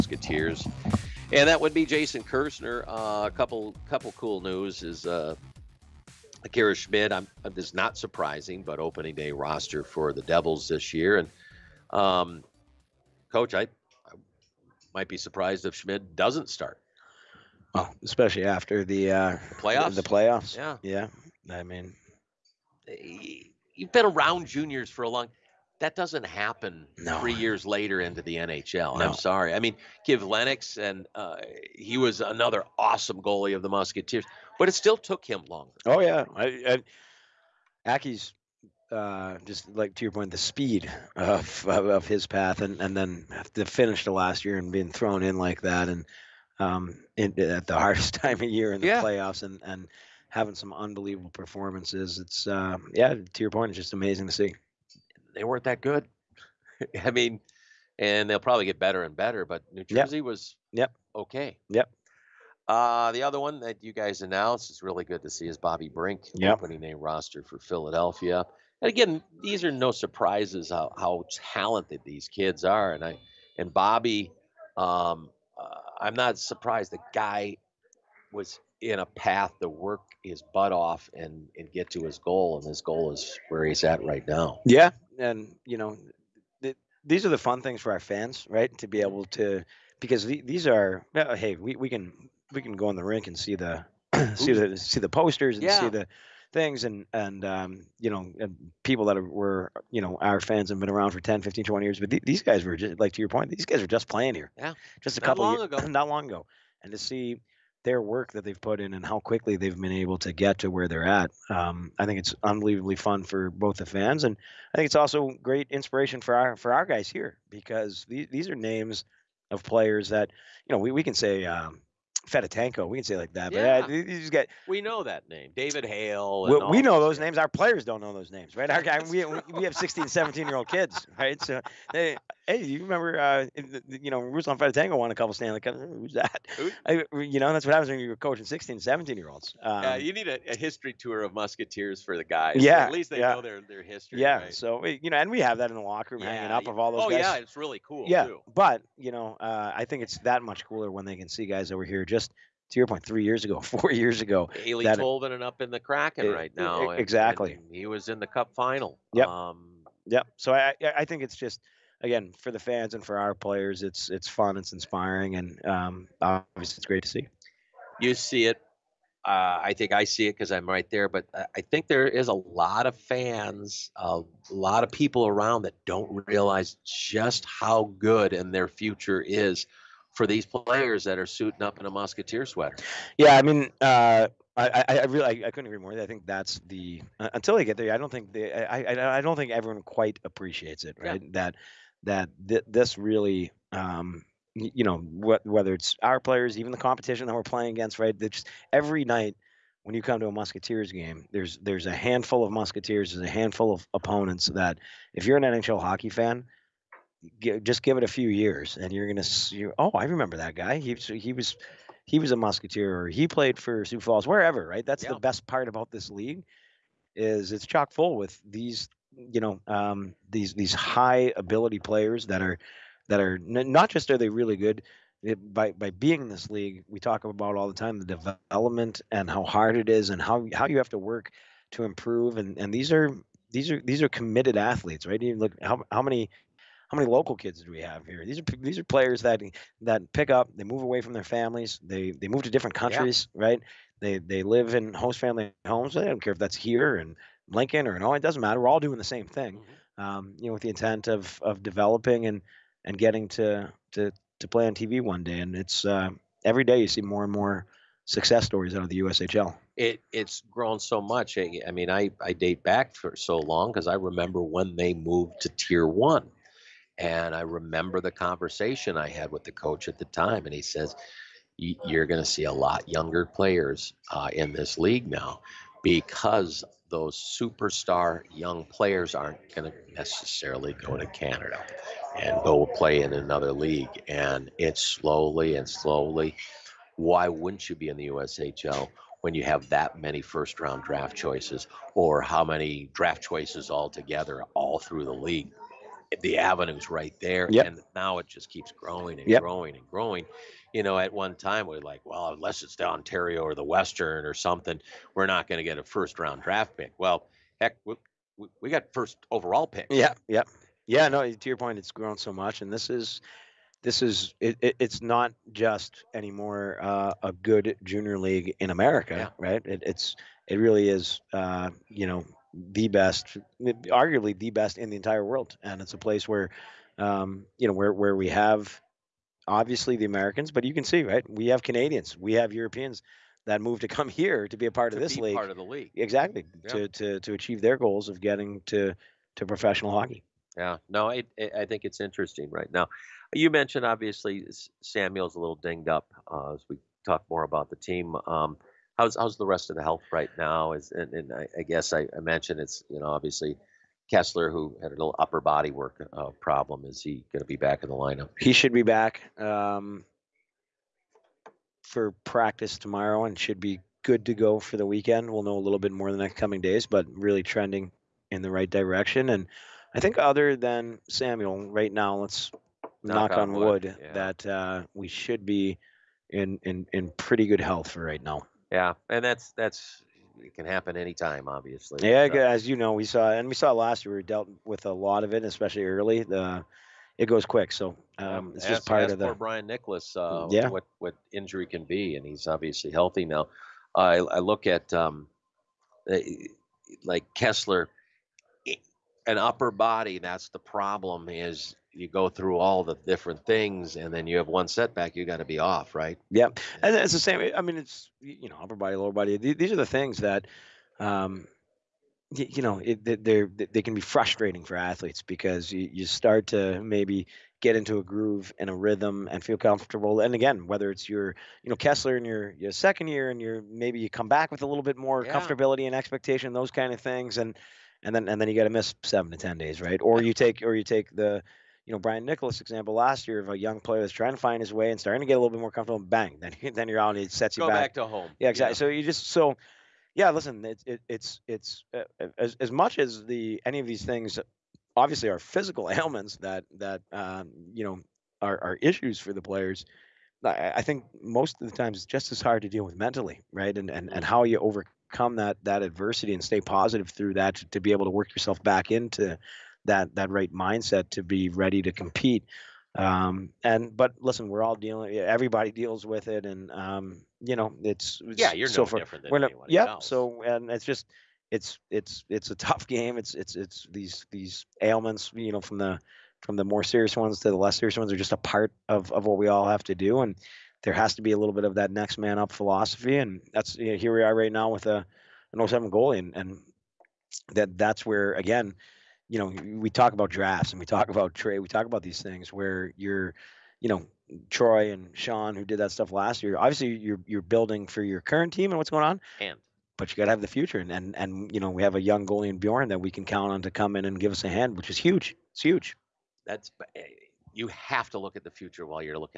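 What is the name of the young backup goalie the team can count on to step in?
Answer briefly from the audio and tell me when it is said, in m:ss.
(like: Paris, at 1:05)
Bjorn, at 8:22.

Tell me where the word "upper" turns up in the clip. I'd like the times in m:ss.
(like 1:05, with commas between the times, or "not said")
5:55, 6:39, 6:48.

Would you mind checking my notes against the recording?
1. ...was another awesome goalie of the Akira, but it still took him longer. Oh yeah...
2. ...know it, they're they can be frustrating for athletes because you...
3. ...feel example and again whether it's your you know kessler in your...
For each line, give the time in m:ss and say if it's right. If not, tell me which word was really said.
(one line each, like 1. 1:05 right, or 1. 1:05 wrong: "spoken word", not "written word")
1. 0:31 wrong: "Musketeers", not "Akira"
2. 6:52 right
3. 6:59 wrong: "comfortable", not "example".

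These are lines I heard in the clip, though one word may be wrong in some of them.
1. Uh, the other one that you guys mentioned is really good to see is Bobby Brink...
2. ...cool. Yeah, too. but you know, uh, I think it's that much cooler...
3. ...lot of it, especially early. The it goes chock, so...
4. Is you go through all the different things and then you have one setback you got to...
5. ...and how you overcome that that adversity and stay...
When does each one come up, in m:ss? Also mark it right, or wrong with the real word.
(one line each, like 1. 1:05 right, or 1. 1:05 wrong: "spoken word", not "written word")
1. 1:02 wrong: "announced", not "mentioned"
2. 2:27 right
3. 6:24 wrong: "quick", not "chock"
4. 6:41 right
5. 7:34 right.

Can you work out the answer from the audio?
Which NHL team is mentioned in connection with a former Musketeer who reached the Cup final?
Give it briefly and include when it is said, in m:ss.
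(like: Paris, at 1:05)
Kraken, at 2:35.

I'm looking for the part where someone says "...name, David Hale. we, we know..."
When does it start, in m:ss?
2:05.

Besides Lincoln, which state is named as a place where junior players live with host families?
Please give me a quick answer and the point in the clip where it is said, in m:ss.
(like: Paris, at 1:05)
Ohio, at 4:08.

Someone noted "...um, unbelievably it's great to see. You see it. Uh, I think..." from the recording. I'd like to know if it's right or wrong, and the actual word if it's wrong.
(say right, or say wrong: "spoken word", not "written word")
wrong: "obviously", not "unbelievably".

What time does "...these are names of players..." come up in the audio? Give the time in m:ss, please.
1:58.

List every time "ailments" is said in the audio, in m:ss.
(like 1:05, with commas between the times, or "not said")
7:25, 7:54.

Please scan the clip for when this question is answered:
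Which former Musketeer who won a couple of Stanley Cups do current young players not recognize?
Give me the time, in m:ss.
2:14.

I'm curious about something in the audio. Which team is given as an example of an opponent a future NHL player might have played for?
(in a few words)
Sioux Falls.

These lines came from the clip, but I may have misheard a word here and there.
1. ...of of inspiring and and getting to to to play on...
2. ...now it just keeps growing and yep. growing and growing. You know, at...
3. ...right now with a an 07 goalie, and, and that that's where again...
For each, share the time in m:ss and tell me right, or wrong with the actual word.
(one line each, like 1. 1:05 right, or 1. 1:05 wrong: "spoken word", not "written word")
1. 4:11 wrong: "developing", not "inspiring"
2. 4:57 right
3. 8:04 right.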